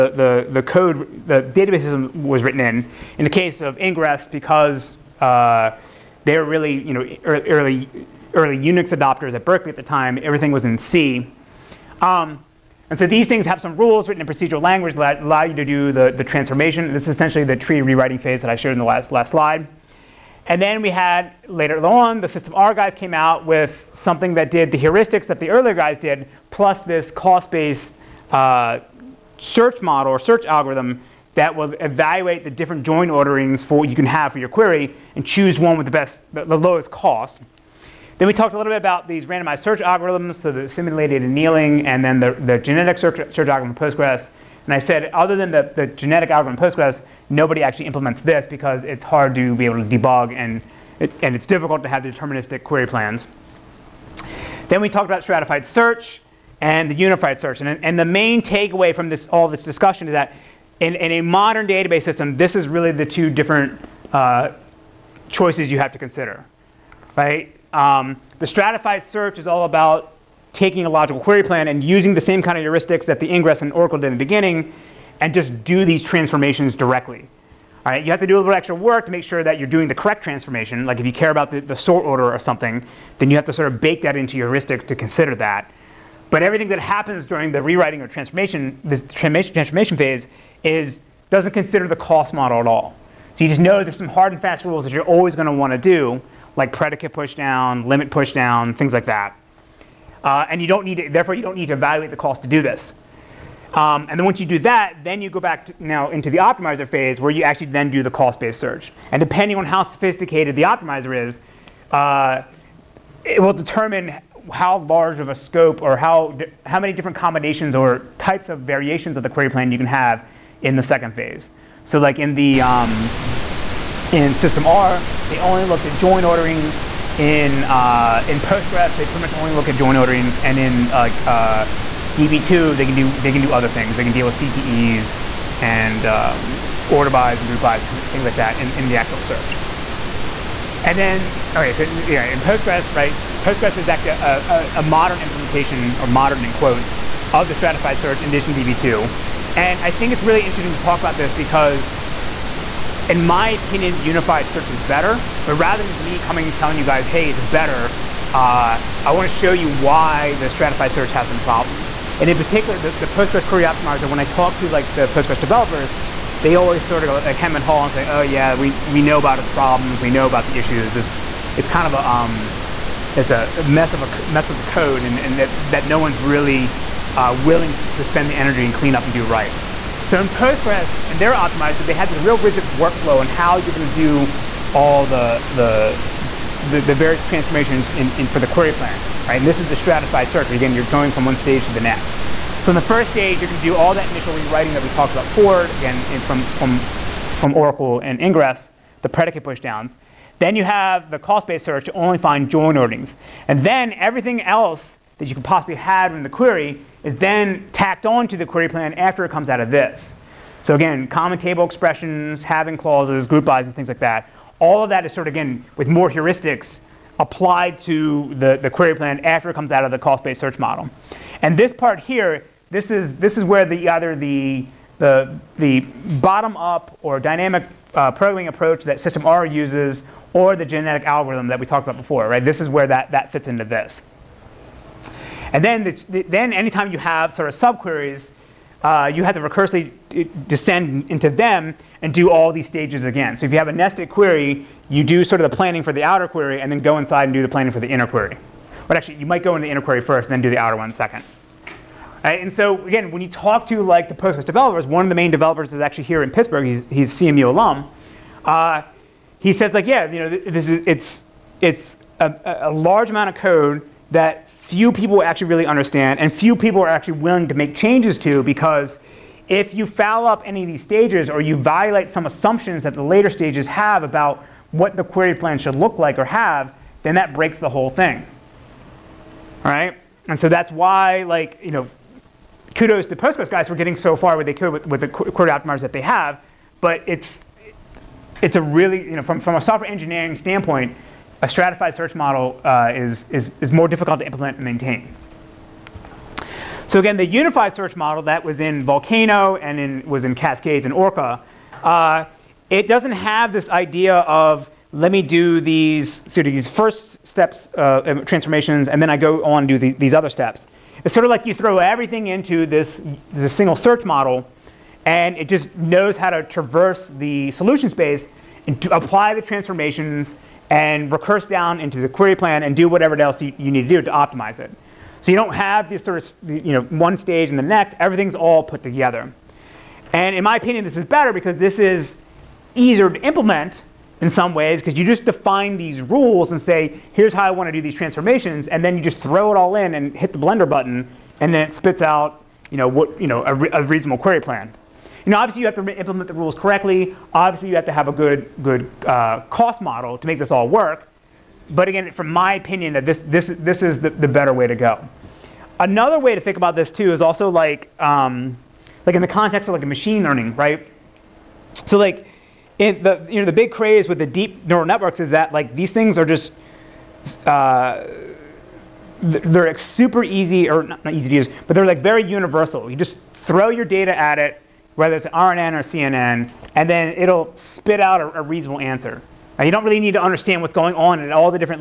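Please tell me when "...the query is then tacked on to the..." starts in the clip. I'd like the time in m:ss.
3:26.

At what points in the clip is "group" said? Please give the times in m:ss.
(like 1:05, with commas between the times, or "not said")
2:17, 3:33.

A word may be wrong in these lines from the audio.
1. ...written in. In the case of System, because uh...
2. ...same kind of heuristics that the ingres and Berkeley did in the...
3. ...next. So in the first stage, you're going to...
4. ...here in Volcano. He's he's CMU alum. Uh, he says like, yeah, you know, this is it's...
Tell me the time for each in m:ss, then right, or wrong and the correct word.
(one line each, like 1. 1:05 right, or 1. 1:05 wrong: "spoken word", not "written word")
1. 0:02 wrong: "Ingres", not "System"
2. 1:12 wrong: "Oracle", not "Berkeley"
3. 3:11 right
4. 4:16 wrong: "Pittsburgh", not "Volcano".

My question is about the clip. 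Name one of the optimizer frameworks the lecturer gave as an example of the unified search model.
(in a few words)
Cascades.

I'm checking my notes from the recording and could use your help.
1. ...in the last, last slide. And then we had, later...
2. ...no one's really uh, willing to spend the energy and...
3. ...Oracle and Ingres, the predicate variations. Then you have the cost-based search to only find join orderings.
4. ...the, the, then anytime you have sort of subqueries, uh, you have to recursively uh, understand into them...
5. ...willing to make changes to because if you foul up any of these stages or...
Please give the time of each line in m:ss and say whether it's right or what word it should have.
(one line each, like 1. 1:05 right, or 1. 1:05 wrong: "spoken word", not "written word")
1. 0:18 right
2. 2:55 right
3. 3:17 wrong: "pushdowns", not "variations"
4. 3:55 wrong: "descend", not "understand"
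5. 4:27 right.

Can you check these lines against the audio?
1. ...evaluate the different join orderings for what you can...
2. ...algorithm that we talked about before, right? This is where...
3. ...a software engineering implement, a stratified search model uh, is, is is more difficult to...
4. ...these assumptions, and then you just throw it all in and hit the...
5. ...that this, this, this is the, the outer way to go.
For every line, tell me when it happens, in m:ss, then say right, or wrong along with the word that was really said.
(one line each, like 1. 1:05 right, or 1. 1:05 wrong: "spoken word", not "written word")
1. 0:31 right
2. 3:51 right
3. 4:49 wrong: "standpoint", not "implement"
4. 5:37 wrong: "transformations", not "assumptions"
5. 5:52 wrong: "better", not "outer".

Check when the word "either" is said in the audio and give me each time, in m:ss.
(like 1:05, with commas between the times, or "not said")
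3:43.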